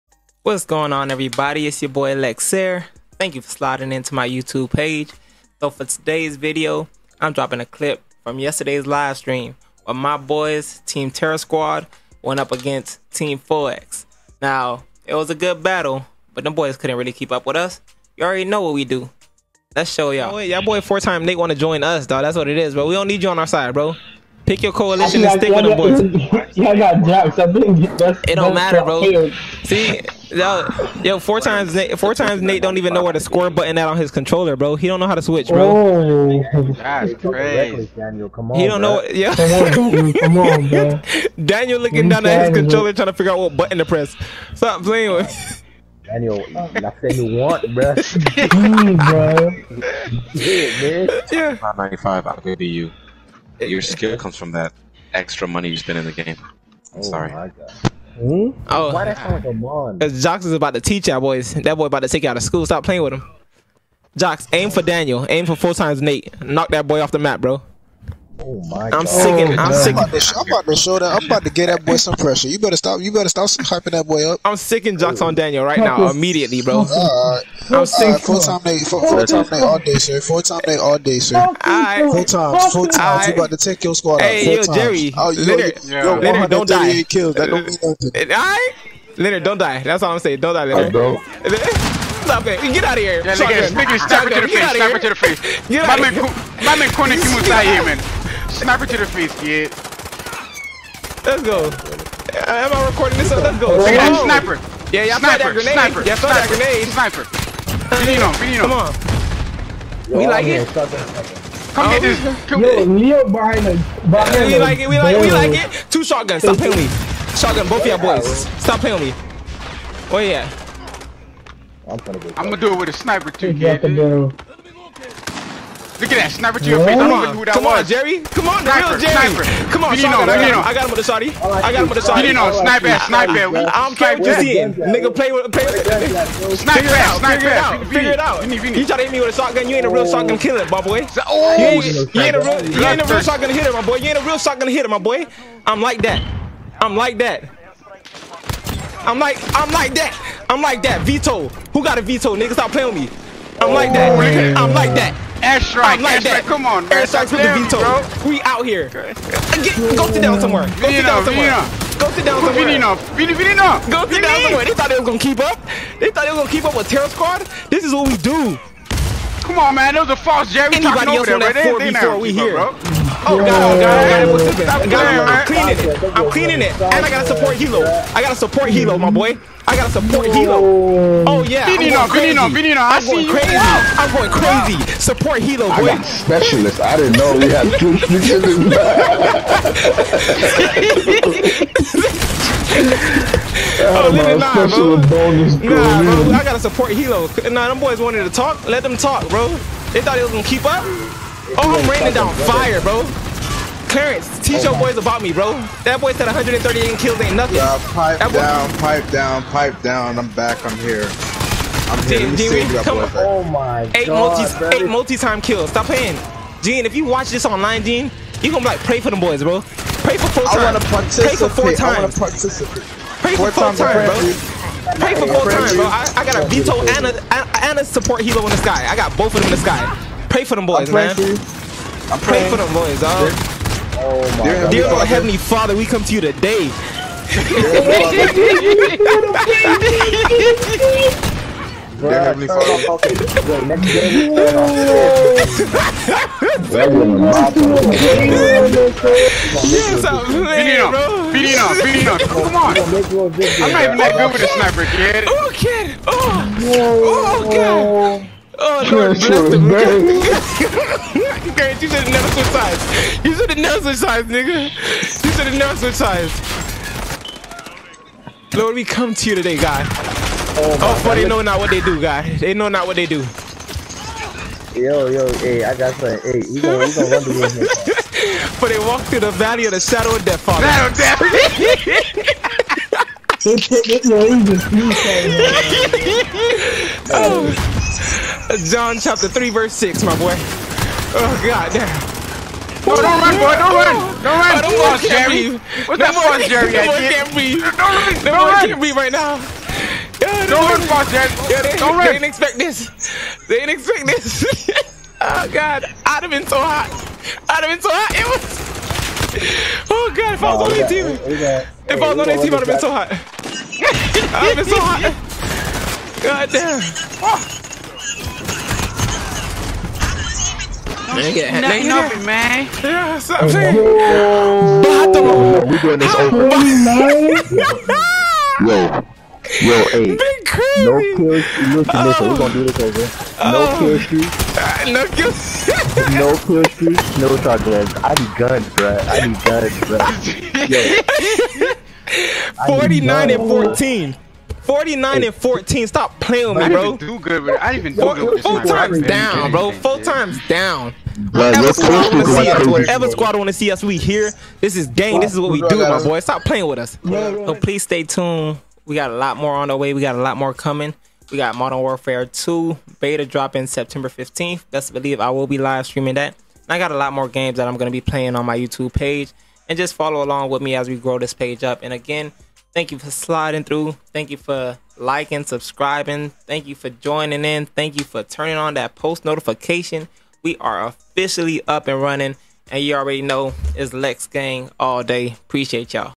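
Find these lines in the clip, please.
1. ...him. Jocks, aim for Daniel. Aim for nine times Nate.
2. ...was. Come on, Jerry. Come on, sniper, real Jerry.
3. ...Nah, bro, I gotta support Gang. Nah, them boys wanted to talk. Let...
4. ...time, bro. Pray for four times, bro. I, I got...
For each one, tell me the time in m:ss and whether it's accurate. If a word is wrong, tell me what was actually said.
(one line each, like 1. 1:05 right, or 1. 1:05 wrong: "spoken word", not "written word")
1. 1:03 wrong: "four", not "nine"
2. 2:07 right
3. 3:15 wrong: "Helo", not "Gang"
4. 3:43 right.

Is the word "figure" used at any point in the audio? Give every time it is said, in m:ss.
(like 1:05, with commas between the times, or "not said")
0:43, 2:17.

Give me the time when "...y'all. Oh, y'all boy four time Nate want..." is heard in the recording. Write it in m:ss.
0:20.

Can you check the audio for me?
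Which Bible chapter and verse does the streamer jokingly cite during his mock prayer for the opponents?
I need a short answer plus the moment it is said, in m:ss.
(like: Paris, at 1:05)
John chapter 3, verse 6, at 4:48.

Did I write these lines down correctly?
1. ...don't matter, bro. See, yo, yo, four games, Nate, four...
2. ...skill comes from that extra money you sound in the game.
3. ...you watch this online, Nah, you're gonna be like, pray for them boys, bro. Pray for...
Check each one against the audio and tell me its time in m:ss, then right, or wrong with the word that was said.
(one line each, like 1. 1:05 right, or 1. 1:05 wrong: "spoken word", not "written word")
1. 0:28 wrong: "times", not "games"
2. 0:53 wrong: "spend", not "sound"
3. 3:36 wrong: "Gene", not "Nah".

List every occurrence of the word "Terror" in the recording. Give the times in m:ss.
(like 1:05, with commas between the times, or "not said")
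0:11, 2:46.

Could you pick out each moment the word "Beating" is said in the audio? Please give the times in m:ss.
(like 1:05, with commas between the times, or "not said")
4:11.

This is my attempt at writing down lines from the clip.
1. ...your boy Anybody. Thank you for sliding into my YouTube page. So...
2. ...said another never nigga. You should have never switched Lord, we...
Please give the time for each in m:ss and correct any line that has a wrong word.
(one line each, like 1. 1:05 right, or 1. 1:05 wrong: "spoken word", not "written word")
1. 0:01 wrong: "Lexair", not "Anybody"
2. 4:23 right.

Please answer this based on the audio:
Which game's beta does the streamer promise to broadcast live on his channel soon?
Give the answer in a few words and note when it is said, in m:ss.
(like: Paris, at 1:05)
Modern Warfare 2, at 6:01.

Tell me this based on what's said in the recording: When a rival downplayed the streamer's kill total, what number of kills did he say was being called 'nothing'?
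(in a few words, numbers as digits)
138.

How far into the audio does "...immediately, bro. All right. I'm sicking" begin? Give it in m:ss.
1:16.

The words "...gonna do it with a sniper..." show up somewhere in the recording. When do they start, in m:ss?
2:02.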